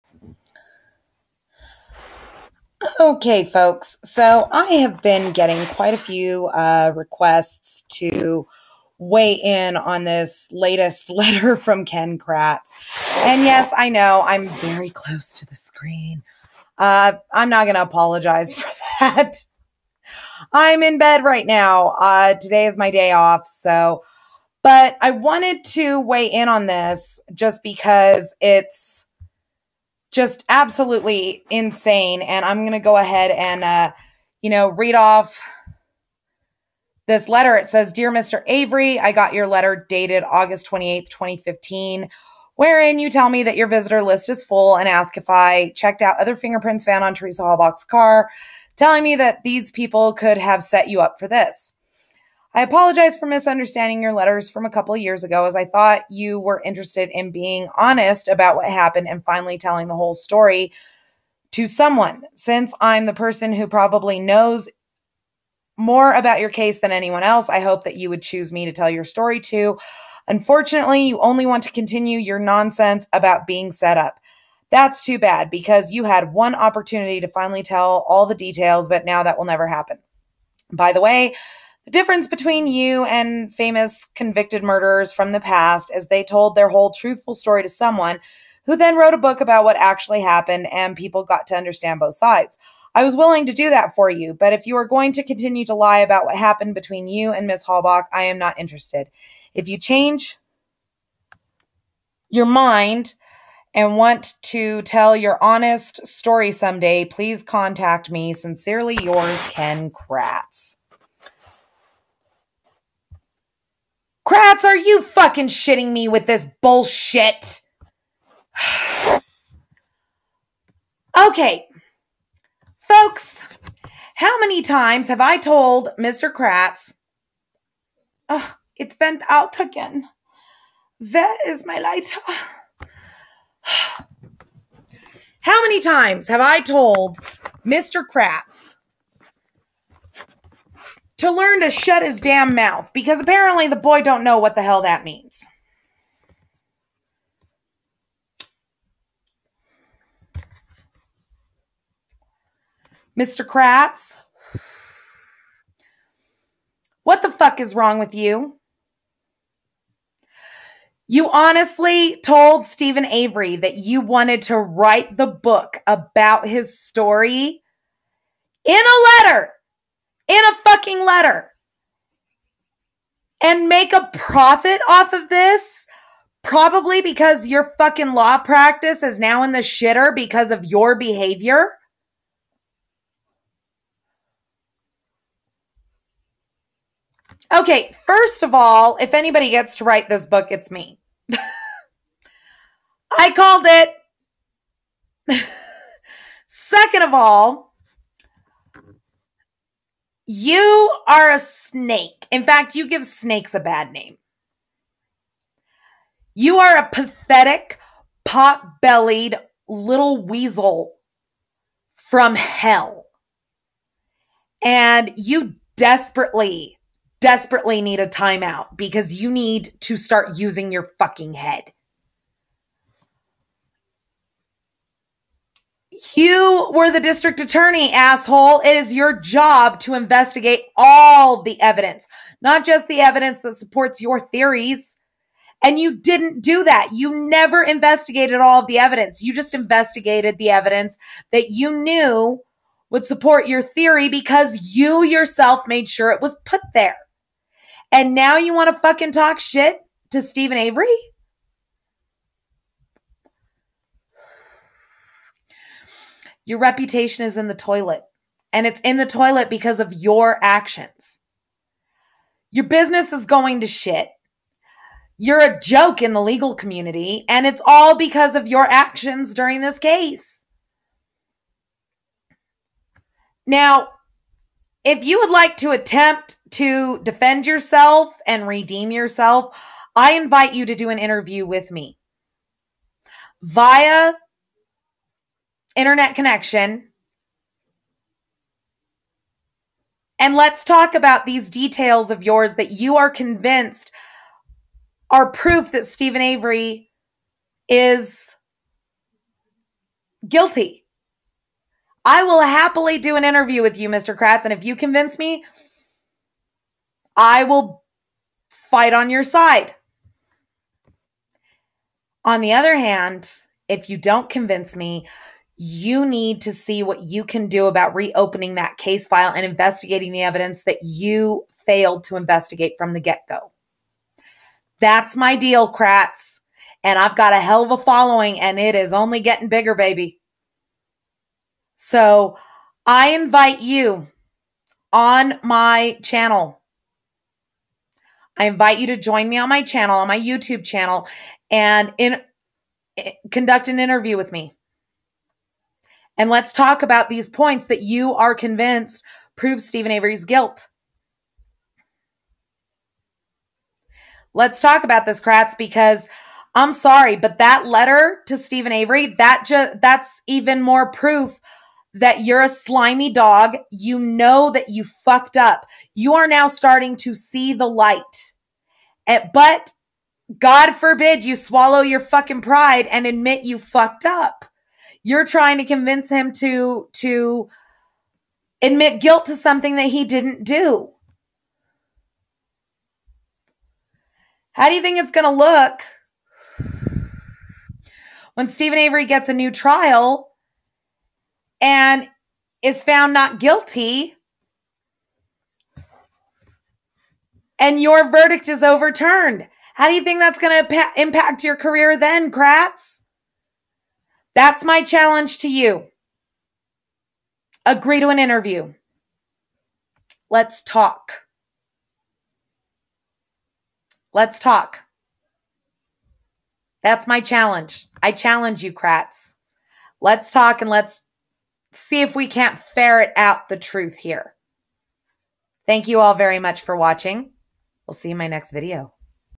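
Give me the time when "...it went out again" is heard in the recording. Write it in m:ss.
2:08.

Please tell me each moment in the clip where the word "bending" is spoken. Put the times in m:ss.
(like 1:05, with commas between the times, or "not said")
not said.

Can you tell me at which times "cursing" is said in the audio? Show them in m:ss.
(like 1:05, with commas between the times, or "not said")
not said.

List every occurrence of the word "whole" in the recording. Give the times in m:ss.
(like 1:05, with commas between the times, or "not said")
0:59, 1:26.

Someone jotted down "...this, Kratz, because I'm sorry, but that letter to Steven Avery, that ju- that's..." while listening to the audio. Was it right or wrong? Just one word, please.
right.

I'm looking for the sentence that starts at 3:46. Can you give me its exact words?
You were the district attorney, asshole.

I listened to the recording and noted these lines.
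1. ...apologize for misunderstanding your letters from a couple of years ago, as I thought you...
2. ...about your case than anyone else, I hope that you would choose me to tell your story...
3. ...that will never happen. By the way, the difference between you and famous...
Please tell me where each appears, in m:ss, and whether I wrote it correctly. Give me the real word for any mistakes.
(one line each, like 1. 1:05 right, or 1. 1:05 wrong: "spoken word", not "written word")
1. 0:52 right
2. 1:06 right
3. 1:19 right.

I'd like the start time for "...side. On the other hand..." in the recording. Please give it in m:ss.
5:09.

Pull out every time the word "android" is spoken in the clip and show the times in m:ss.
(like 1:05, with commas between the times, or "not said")
not said.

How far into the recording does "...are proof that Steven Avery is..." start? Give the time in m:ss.
4:55.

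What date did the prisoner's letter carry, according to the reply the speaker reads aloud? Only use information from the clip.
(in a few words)
August 28th, 2015.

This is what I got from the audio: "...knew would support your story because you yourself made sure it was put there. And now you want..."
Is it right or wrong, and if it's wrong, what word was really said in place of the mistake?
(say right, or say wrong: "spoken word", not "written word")
wrong: "theory", not "story".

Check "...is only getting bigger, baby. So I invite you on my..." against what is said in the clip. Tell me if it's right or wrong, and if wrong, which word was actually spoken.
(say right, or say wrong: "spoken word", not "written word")
right.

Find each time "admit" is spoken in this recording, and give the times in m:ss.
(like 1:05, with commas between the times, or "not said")
6:13, 6:18.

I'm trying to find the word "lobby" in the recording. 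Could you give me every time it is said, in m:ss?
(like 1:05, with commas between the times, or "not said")
not said.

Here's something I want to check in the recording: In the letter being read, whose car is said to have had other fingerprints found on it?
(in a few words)
Teresa Halbach.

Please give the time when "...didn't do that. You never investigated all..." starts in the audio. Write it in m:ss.
3:55.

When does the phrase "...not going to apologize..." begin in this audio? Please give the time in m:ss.
0:17.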